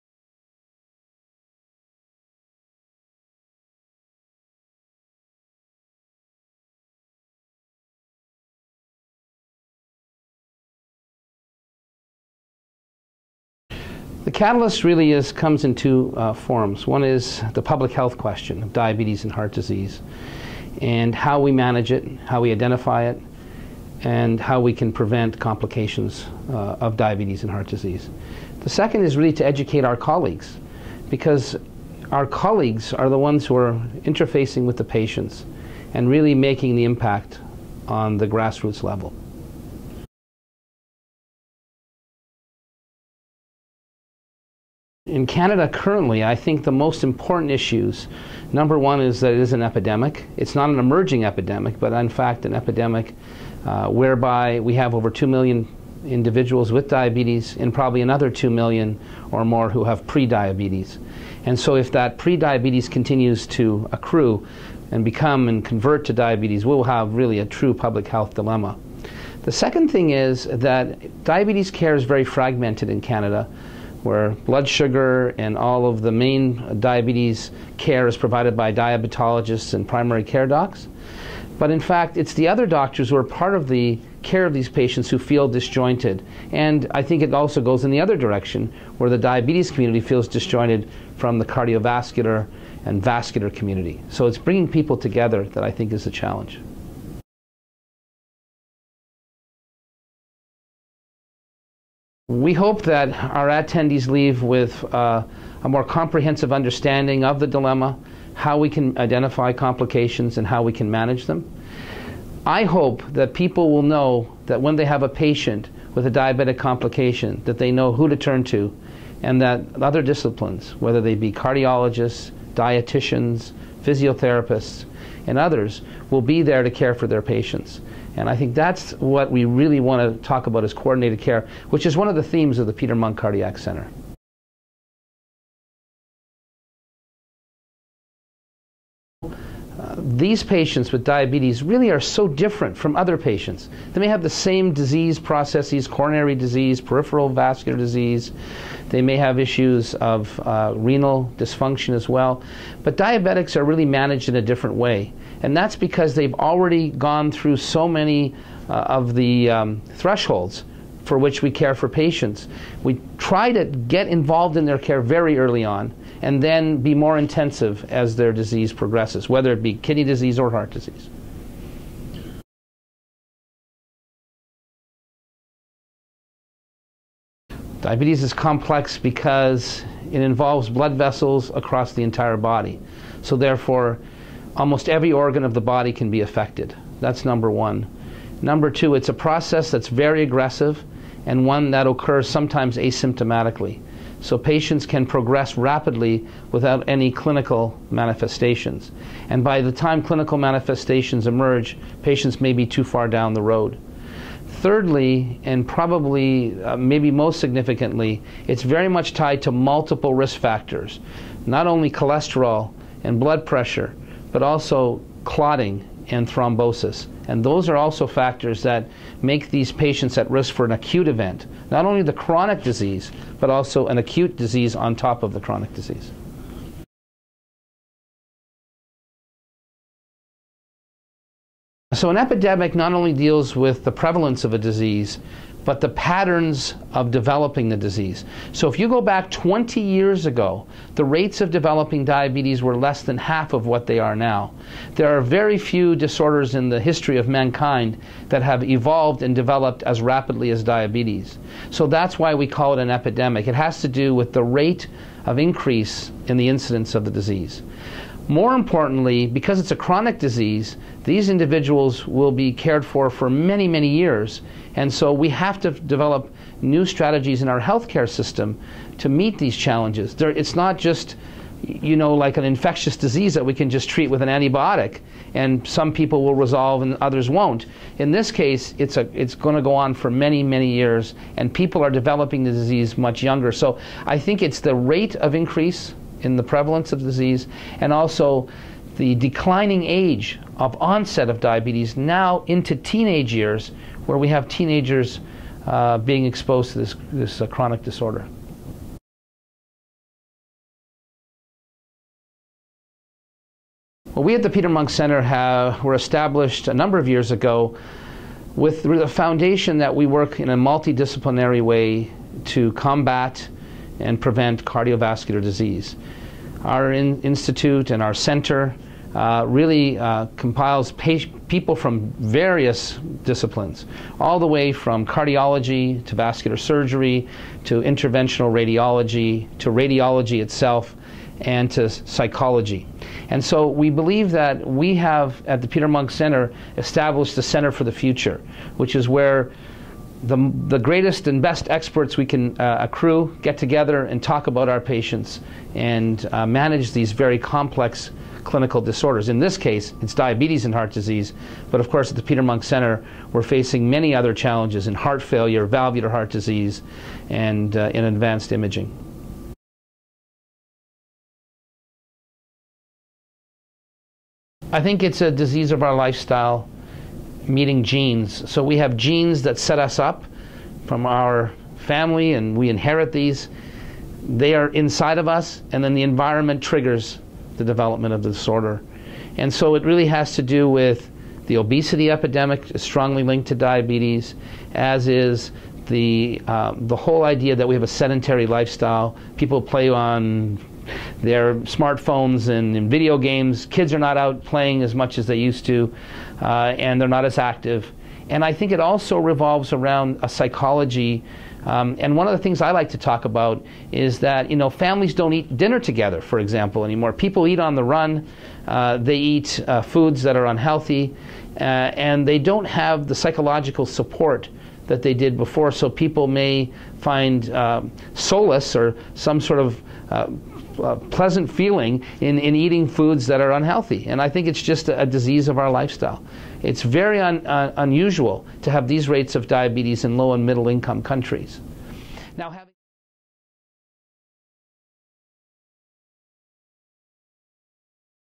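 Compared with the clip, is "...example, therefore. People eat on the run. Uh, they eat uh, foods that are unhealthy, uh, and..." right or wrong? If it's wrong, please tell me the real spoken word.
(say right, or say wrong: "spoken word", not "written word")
wrong: "anymore", not "therefore".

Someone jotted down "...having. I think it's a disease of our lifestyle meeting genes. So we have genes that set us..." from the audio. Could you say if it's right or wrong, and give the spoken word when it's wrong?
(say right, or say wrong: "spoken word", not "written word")
wrong: "imaging", not "having".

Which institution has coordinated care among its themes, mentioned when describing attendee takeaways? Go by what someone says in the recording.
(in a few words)
Peter Munk Cardiac Center.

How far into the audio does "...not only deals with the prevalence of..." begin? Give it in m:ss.
3:52.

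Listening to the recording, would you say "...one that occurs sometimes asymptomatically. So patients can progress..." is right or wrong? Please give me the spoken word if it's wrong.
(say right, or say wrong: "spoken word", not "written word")
right.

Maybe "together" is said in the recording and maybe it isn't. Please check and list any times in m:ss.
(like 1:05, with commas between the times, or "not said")
1:34, 5:43, 6:45.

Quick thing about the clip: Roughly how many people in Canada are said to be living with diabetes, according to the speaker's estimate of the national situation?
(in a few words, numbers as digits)
over 2 million.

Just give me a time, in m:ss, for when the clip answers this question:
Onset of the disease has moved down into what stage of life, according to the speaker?
4:52.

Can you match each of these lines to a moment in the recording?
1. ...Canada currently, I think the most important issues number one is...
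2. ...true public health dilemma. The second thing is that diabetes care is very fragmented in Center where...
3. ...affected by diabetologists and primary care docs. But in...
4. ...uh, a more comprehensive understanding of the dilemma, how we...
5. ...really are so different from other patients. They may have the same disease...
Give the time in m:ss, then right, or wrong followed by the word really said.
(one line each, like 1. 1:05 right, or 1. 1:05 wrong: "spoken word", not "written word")
1. 0:45 right
2. 1:07 wrong: "Canada", not "Center"
3. 1:18 wrong: "provided", not "affected"
4. 1:44 right
5. 2:21 right.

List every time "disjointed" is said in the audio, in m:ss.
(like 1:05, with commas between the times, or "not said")
1:25, 1:30.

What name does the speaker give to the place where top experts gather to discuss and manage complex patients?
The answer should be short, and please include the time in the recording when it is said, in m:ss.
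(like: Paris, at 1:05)
Center for the Future, at 5:37.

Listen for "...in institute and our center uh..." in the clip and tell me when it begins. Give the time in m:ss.
5:16.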